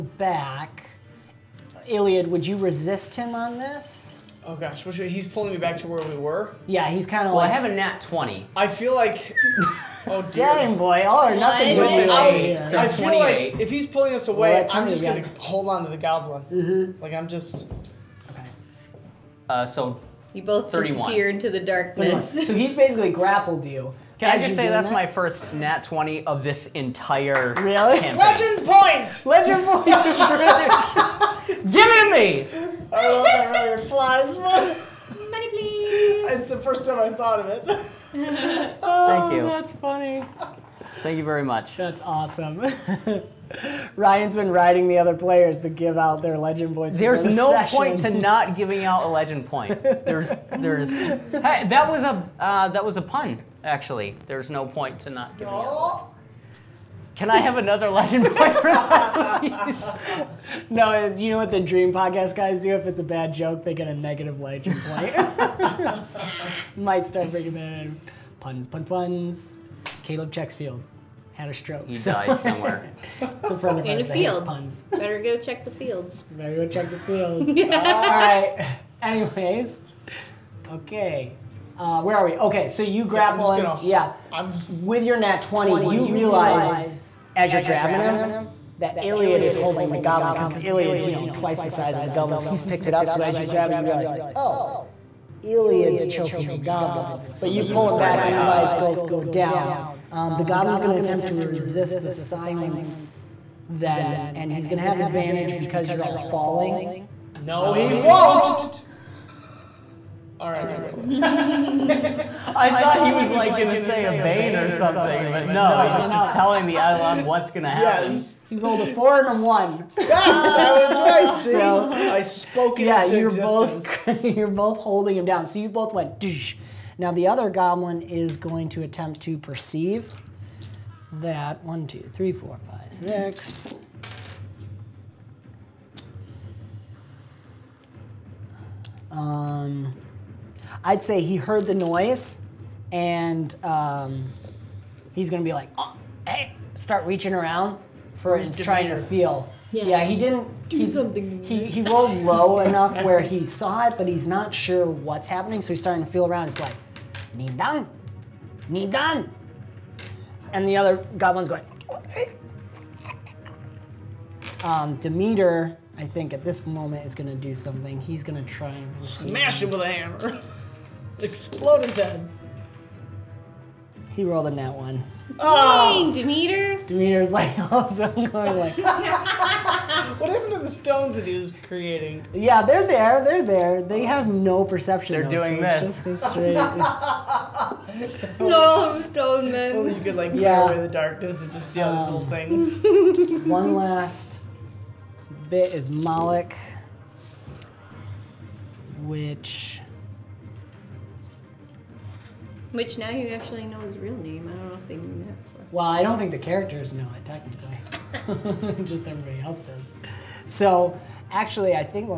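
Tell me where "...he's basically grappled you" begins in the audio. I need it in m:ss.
0:22.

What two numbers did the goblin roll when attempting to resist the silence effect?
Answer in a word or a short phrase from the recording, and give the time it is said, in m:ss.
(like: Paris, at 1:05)
4 and 1, at 1:58.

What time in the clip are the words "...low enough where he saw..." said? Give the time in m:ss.
2:32.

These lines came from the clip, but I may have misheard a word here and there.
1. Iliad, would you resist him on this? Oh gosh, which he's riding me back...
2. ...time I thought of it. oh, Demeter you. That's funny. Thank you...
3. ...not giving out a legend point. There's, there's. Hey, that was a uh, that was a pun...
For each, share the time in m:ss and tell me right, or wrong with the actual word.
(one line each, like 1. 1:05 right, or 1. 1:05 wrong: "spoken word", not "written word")
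1. 0:01 wrong: "pulling", not "riding"
2. 0:36 wrong: "Thank", not "Demeter"
3. 0:48 right.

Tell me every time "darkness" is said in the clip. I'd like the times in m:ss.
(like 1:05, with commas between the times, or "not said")
0:21, 3:10.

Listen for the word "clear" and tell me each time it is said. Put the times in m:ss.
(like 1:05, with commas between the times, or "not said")
3:10.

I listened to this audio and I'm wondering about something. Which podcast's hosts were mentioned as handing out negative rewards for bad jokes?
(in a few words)
Dream Podcast.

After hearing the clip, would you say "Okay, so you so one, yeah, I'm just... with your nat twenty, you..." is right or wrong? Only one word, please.
right.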